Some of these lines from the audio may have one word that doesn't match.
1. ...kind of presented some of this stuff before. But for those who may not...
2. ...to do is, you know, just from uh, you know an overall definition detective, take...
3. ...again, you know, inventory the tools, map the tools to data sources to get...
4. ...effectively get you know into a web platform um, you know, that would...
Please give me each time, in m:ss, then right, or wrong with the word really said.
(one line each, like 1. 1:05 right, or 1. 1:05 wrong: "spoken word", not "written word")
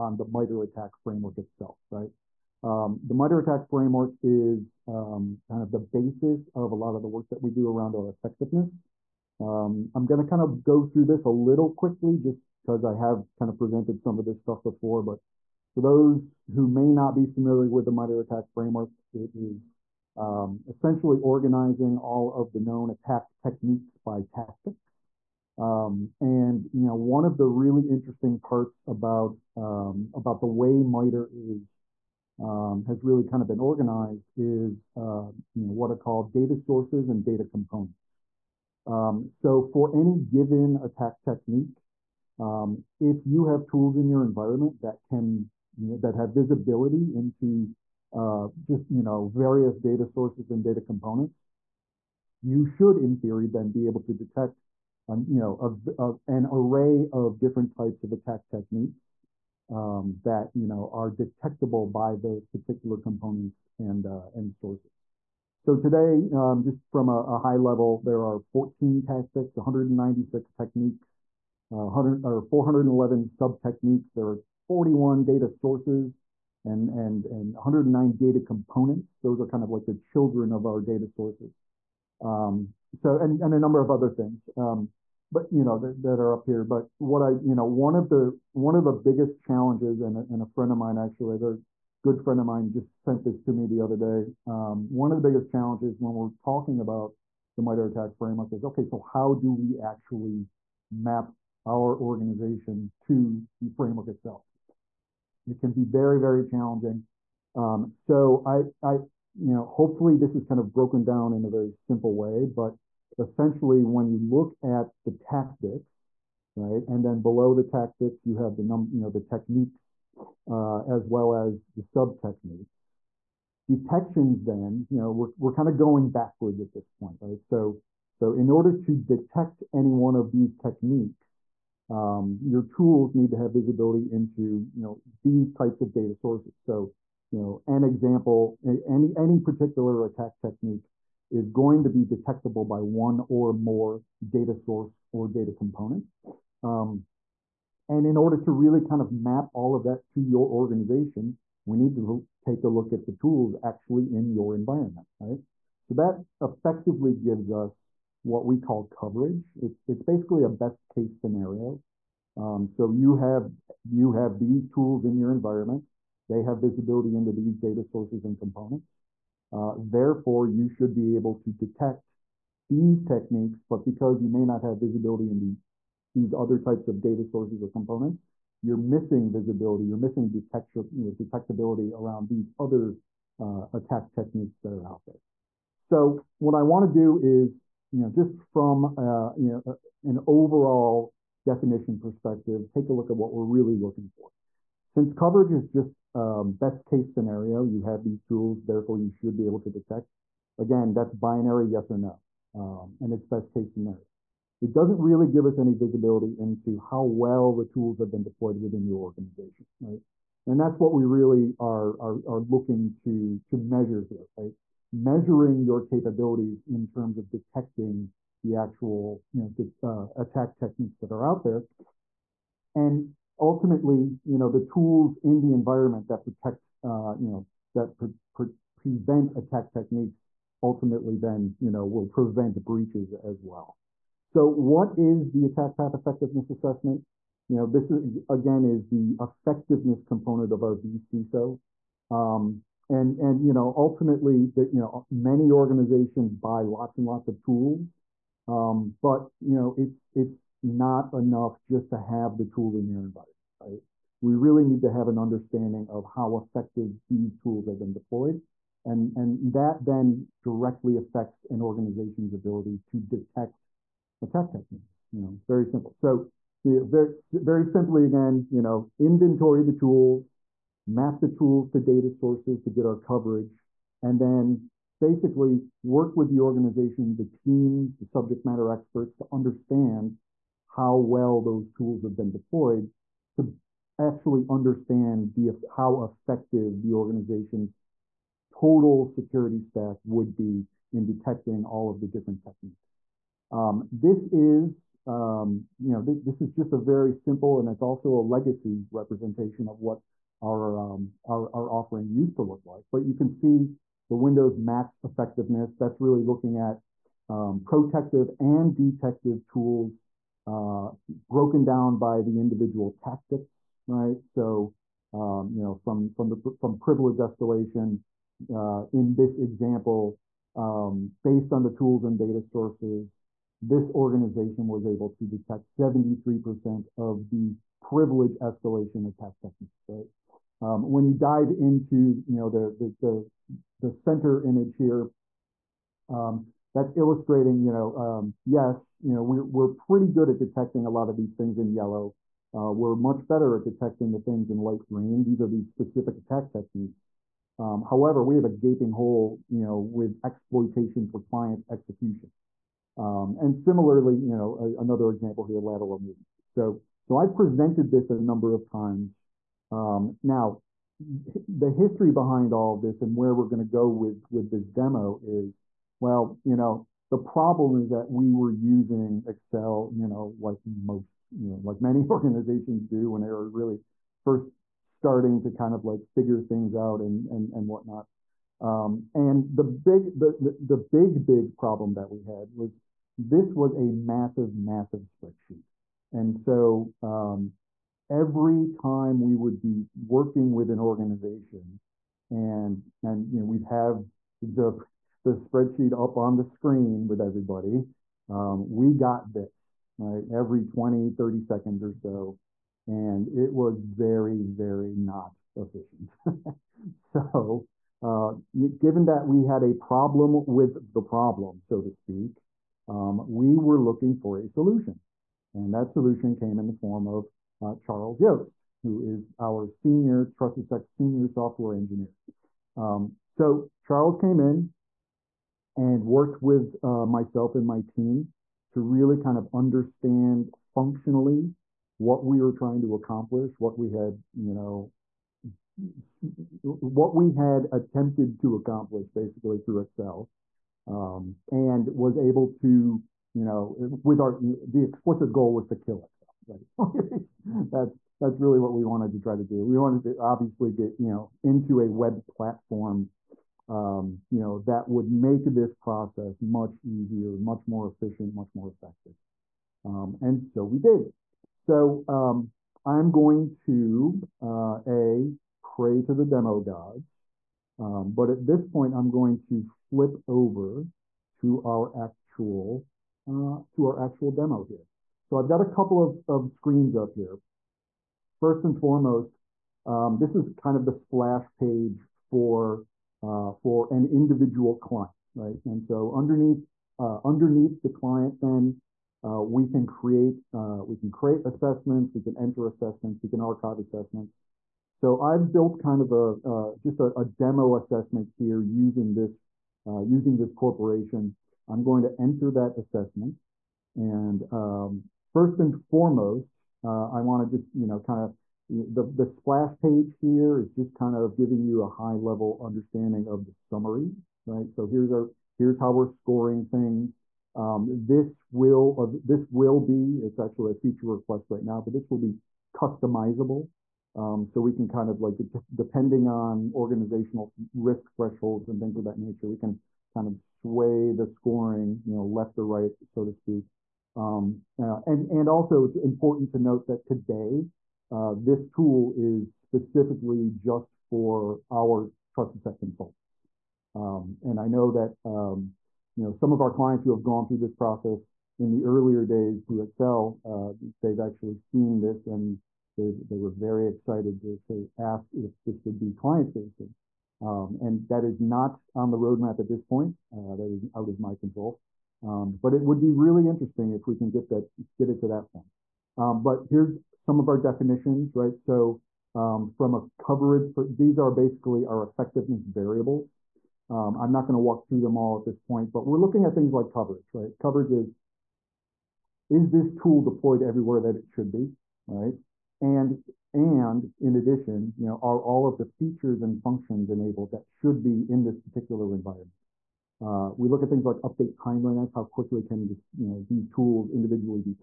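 1. 0:13 right
2. 3:06 wrong: "perspective", not "detective"
3. 4:28 right
4. 7:30 wrong: "obviously", not "effectively".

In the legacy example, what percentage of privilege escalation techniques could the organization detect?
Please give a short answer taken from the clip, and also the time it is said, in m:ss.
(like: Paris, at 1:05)
73%, at 5:25.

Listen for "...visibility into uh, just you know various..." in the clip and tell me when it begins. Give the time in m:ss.
0:46.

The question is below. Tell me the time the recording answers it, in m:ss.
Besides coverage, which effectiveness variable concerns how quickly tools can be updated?
9:51.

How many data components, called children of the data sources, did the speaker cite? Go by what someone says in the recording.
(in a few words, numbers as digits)
109.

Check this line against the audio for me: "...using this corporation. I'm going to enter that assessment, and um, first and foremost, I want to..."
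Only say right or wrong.
right.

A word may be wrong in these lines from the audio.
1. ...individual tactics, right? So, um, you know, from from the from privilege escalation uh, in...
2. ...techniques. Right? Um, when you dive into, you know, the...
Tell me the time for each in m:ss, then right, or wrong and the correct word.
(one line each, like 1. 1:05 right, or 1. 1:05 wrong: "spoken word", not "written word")
1. 5:12 right
2. 5:29 right.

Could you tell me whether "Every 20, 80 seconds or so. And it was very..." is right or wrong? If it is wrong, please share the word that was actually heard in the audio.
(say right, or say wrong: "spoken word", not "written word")
wrong: "30", not "80".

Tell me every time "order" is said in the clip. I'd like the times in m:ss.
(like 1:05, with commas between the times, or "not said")
2:08, 2:28.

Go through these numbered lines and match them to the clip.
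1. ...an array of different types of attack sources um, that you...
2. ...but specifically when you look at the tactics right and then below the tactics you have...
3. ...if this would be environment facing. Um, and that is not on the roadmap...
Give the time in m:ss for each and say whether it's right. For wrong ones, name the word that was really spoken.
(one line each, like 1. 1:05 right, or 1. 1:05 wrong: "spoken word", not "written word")
1. 0:56 wrong: "techniques", not "sources"
2. 1:52 wrong: "essentially", not "specifically"
3. 9:15 wrong: "client", not "environment".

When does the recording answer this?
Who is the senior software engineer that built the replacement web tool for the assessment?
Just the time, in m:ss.
6:57.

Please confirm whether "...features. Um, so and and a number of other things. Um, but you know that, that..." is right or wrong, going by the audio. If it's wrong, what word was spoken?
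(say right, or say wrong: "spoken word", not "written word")
wrong: "sources", not "features".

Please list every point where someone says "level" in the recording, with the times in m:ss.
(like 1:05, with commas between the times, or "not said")
1:07, 8:32.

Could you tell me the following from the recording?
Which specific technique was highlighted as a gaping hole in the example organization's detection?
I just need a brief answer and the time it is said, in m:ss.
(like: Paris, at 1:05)
exploitation for client execution, at 5:50.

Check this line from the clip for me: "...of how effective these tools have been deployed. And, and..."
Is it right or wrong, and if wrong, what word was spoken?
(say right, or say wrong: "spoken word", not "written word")
right.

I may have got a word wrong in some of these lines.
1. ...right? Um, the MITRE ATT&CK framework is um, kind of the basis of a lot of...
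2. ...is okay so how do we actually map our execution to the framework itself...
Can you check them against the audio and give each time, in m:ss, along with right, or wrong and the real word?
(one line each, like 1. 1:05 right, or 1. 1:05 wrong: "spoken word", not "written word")
1. 0:01 right
2. 1:38 wrong: "organization", not "execution".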